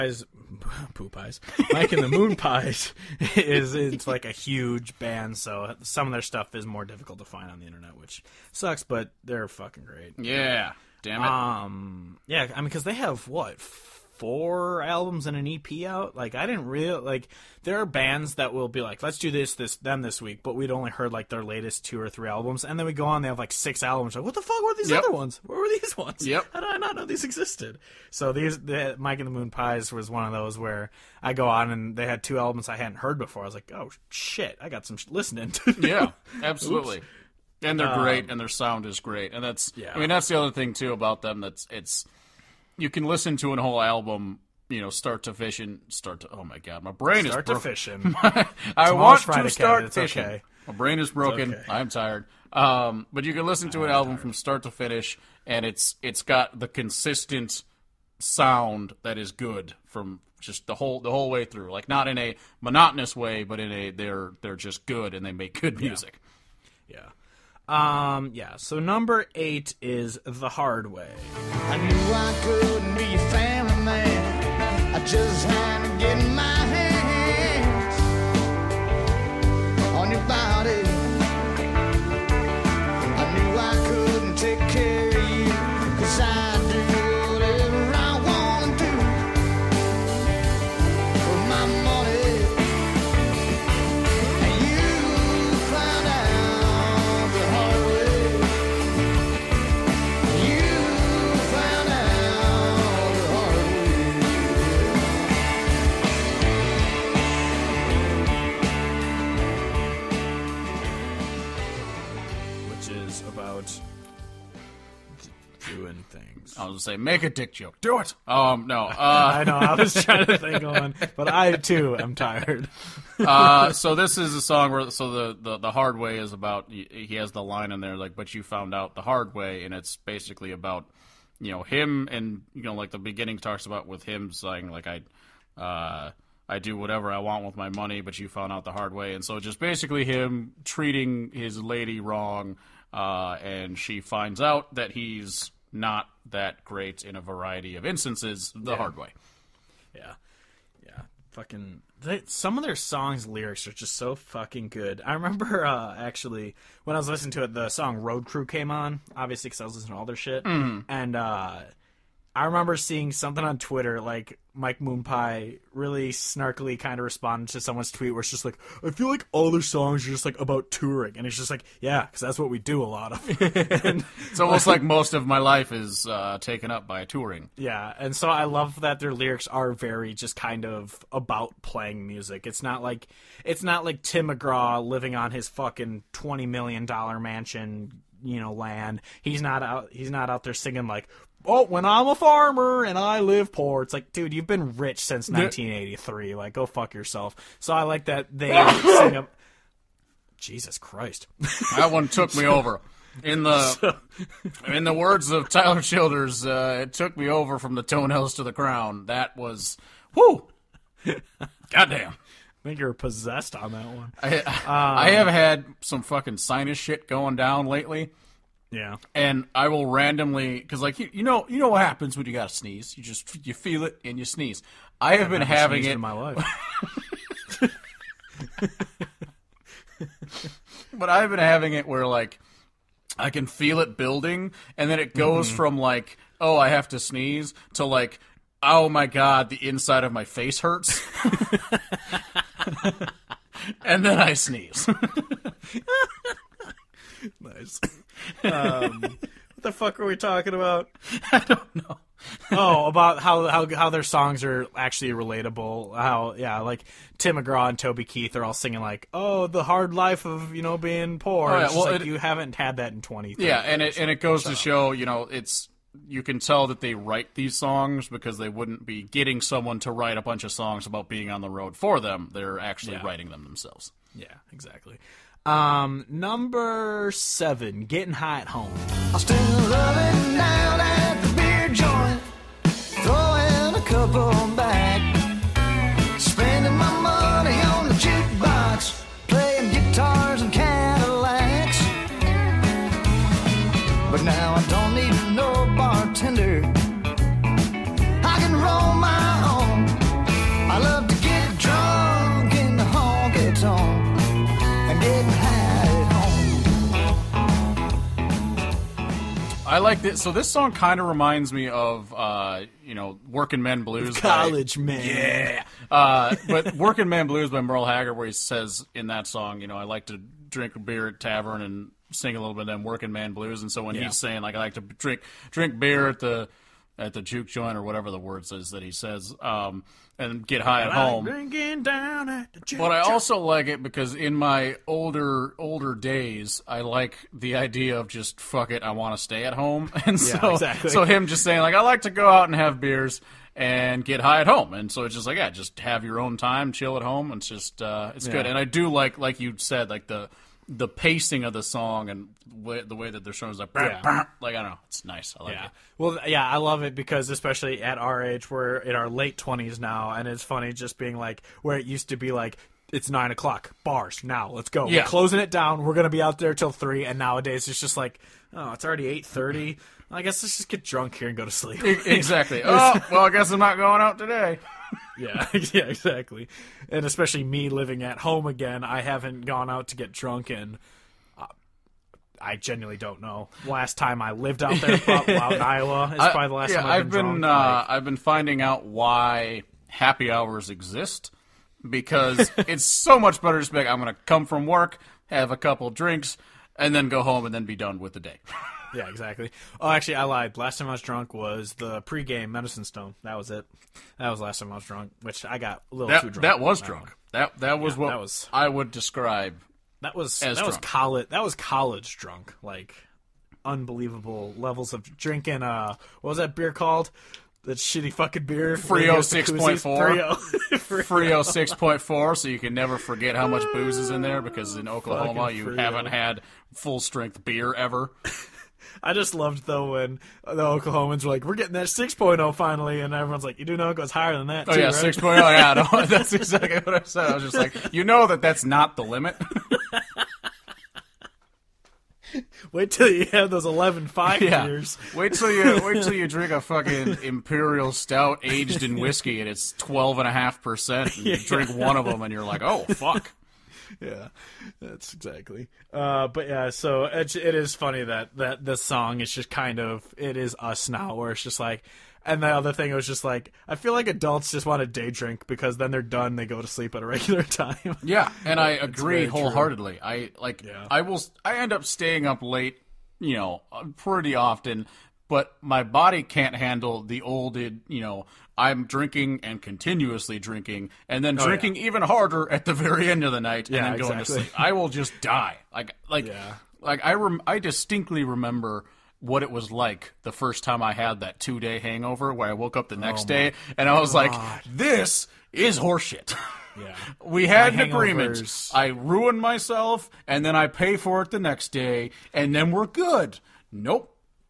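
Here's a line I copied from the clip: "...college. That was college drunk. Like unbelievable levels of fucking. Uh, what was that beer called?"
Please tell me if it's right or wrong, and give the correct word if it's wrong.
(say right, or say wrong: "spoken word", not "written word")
wrong: "drinking", not "fucking".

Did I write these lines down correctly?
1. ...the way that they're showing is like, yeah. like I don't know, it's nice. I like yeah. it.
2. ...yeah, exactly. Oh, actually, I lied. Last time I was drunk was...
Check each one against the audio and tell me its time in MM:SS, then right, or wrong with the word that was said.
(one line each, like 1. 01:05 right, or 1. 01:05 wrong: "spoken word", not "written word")
1. 05:52 right
2. 06:38 right.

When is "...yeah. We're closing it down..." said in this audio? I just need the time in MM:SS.
06:04.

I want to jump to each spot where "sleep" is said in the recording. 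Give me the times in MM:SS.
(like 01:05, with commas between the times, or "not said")
06:11, 07:46, 08:04.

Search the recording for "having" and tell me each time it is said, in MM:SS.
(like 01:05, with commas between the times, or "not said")
03:45, 03:51.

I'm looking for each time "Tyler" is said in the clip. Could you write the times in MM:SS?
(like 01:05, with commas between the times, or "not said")
03:25.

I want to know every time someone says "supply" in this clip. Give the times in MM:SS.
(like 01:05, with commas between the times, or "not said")
not said.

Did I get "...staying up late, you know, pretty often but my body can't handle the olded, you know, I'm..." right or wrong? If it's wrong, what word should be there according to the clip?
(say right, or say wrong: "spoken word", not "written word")
right.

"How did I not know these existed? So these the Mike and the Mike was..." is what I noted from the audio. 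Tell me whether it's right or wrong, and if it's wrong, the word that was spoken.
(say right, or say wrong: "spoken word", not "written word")
wrong: "Moonpies", not "Mike".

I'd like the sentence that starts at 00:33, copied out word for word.
I was like, oh shit, I got some sh- listening to.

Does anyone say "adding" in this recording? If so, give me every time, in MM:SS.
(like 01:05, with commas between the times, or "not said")
not said.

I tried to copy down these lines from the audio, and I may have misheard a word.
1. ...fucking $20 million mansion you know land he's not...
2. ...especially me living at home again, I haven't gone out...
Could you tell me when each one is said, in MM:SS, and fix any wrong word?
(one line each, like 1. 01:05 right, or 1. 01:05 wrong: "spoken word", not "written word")
1. 03:05 right
2. 06:17 right.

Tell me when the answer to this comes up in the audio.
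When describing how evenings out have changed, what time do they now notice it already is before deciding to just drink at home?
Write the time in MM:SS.
06:09.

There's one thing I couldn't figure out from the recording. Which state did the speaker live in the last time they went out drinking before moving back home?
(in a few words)
Iowa.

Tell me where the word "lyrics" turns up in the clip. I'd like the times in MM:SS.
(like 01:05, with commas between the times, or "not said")
02:33, 02:59.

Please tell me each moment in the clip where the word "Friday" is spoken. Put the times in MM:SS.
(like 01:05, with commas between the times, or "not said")
00:49.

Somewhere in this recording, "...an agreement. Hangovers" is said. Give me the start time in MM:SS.
08:17.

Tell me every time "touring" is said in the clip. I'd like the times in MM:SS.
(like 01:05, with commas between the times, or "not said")
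02:50, 02:57.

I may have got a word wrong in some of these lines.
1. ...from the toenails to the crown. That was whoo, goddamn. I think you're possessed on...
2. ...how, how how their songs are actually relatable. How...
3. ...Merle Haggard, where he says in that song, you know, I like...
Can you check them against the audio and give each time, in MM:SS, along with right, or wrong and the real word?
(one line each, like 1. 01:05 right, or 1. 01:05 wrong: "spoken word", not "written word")
1. 03:27 right
2. 04:13 right
3. 05:17 right.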